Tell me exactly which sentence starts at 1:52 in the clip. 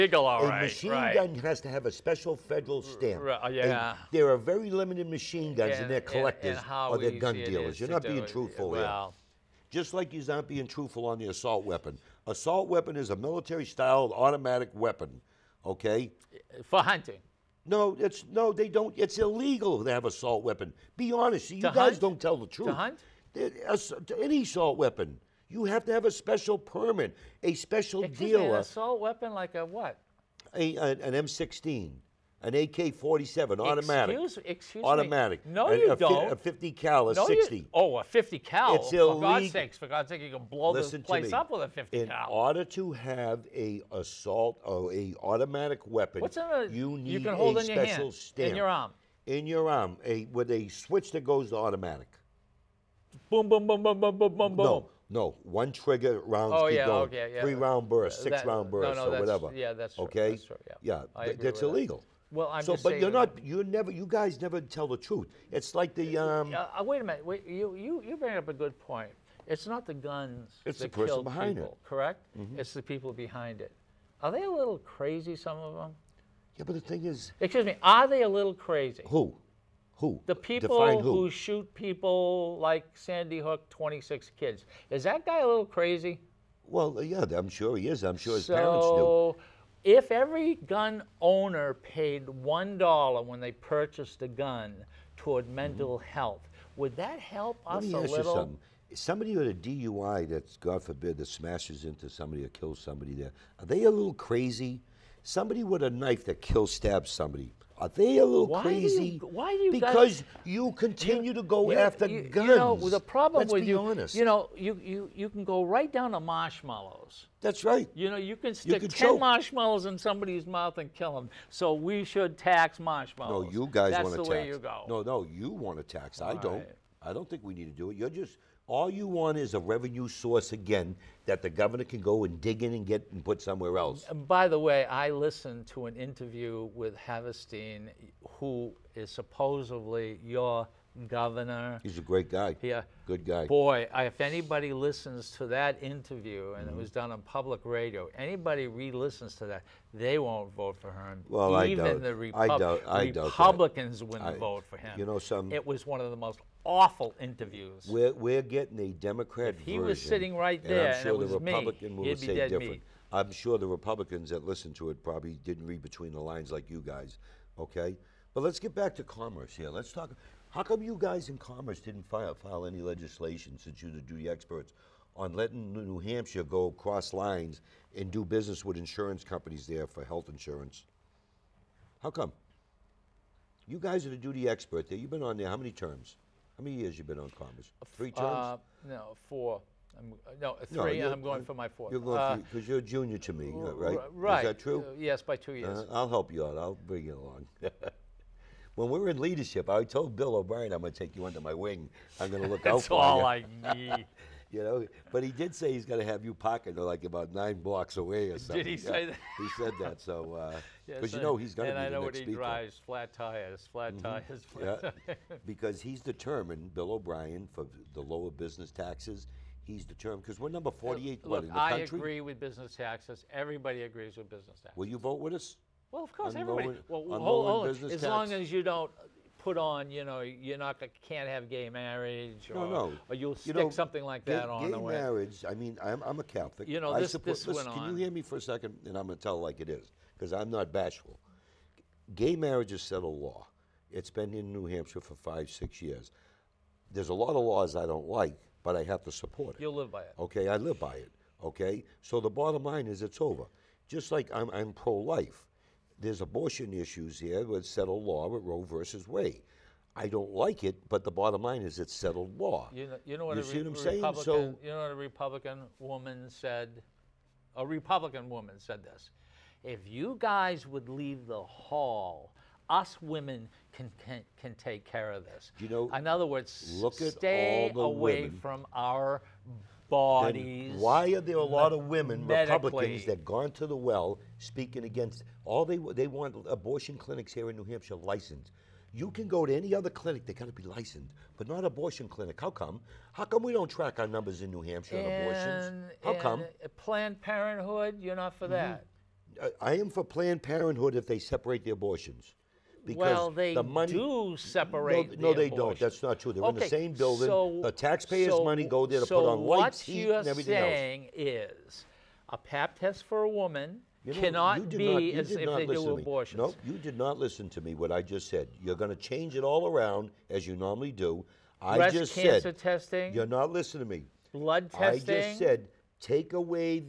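You know, the problem Let's with you, honest.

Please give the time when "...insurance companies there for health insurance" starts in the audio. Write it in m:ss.
2:58.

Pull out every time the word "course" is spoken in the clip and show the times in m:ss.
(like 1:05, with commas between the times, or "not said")
3:46.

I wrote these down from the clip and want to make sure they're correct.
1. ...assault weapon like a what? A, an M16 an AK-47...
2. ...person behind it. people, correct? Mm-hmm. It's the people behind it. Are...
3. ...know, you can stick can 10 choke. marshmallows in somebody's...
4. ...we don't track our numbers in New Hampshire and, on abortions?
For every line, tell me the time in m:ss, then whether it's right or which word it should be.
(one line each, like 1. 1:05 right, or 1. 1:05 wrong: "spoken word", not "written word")
1. 0:28 right
2. 1:10 right
3. 1:58 right
4. 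4:53 right.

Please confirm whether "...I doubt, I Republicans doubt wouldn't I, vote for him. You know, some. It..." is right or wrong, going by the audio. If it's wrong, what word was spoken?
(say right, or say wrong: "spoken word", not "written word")
right.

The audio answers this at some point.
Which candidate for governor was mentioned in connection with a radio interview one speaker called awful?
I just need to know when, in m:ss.
2:16.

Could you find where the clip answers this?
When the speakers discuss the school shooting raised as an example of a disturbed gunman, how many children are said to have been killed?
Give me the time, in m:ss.
1:23.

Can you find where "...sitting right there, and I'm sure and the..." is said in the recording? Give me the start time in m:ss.
2:40.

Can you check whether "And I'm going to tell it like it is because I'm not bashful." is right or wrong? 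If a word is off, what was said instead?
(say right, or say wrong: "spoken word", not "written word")
right.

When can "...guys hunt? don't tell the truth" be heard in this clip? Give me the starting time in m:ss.
0:21.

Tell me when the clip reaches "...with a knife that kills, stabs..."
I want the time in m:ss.
1:45.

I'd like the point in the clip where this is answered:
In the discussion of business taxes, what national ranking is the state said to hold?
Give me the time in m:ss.
3:40.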